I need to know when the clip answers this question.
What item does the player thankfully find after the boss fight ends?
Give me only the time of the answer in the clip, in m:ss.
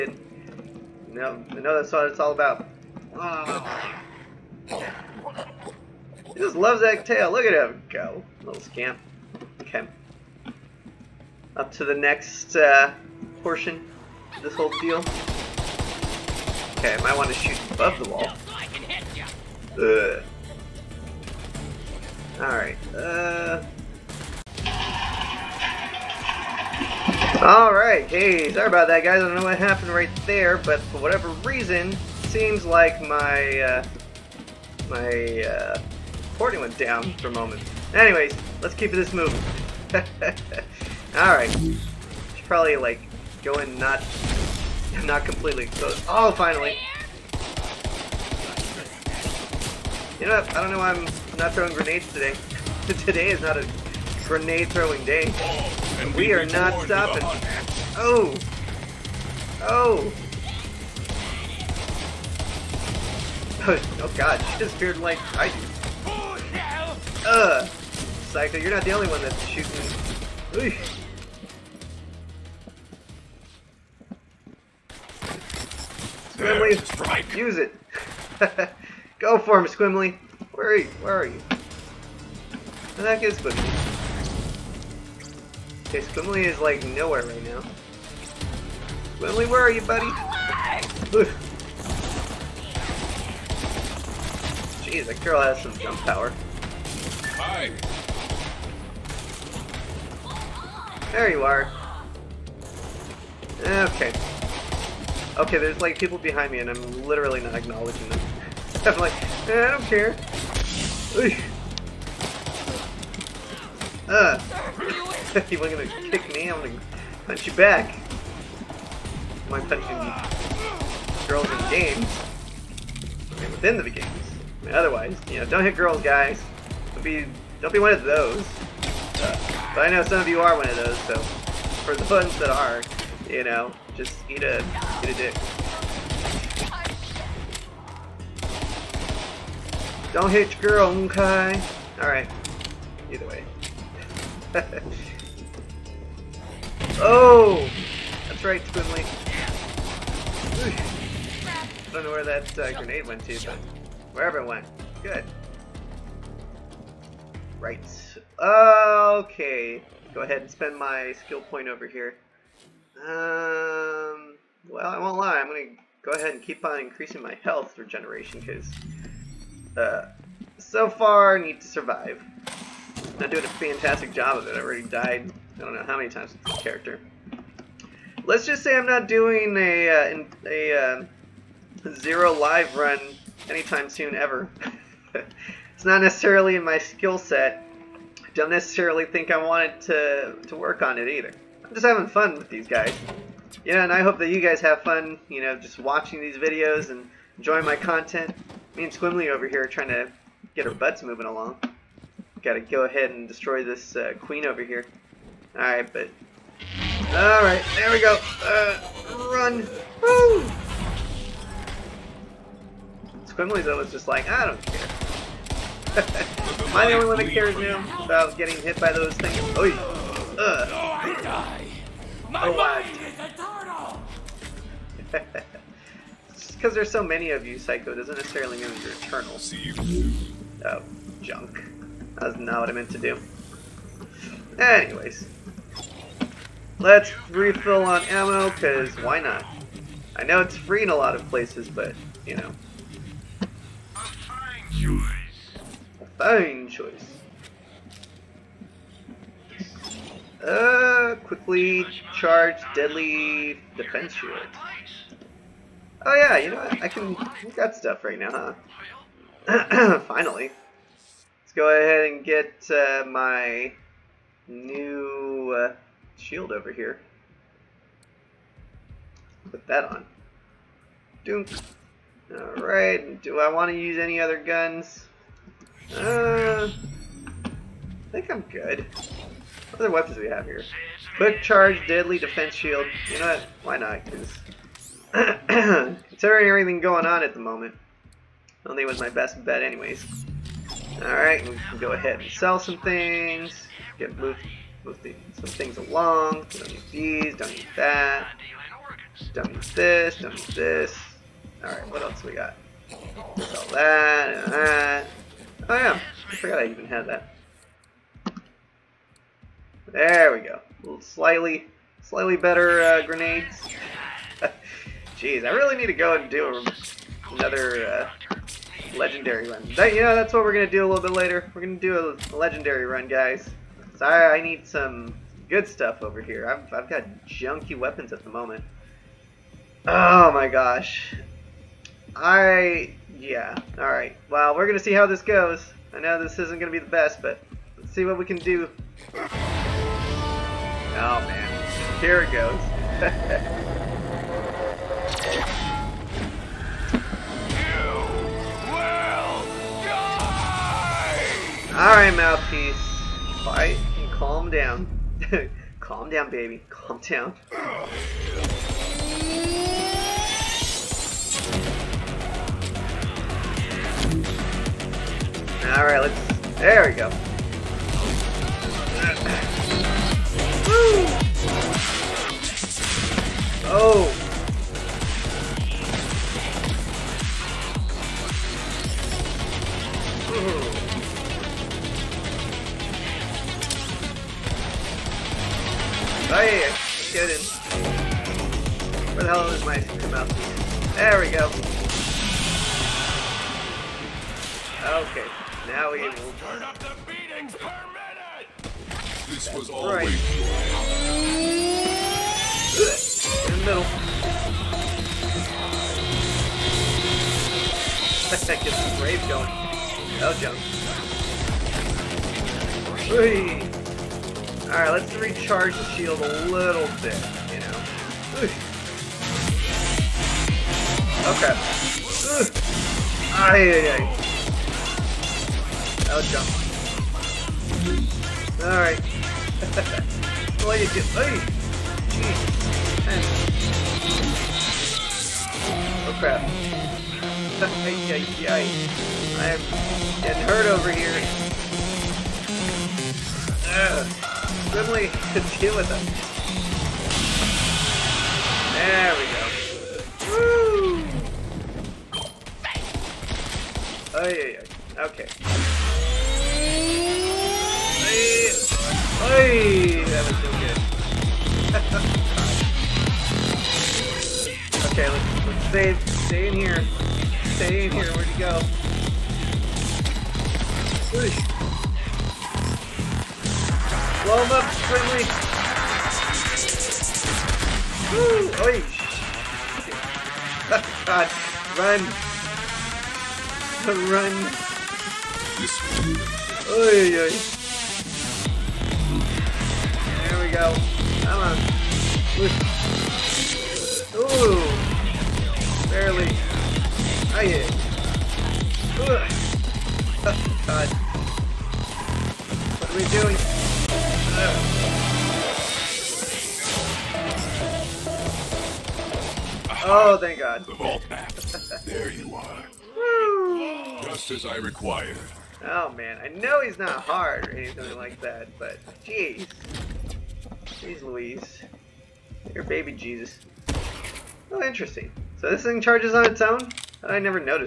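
8:30.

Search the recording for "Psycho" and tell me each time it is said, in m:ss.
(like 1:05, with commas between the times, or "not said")
1:07, 3:47.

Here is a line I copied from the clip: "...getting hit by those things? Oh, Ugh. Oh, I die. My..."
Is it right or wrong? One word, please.
right.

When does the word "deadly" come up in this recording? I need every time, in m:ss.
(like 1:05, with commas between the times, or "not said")
4:12, 4:41.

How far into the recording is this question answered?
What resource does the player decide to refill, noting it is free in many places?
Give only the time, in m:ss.
3:58.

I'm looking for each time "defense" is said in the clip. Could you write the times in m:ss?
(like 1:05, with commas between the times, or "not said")
4:13, 4:42.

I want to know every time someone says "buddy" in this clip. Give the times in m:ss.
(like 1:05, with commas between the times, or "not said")
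1:29.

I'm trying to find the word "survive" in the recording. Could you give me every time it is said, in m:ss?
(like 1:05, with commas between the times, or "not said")
2:51.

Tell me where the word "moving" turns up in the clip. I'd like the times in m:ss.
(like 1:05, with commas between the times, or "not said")
0:39, 3:21.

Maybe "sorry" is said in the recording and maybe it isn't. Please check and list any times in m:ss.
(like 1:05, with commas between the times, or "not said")
0:28.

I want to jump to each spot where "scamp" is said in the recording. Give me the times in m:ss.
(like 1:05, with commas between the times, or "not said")
0:08.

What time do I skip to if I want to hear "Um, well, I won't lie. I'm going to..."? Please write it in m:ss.
2:43.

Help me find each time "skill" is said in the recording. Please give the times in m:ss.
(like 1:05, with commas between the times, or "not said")
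2:41, 3:06.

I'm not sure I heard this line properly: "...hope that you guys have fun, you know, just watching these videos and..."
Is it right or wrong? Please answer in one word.
right.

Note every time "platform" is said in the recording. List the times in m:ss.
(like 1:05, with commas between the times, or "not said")
not said.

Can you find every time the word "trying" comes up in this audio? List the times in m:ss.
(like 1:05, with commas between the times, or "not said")
3:19.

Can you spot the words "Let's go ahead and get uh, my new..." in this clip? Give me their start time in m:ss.
4:21.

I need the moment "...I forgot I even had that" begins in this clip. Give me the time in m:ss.
5:06.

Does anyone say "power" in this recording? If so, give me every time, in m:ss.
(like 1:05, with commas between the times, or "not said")
1:35.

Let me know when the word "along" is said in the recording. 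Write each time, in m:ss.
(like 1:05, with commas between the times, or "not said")
3:21, 4:55.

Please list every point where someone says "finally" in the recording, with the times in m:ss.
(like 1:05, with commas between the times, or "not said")
0:46, 4:20.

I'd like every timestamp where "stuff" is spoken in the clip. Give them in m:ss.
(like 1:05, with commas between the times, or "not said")
4:17, 5:25.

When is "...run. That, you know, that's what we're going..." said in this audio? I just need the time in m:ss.
5:19.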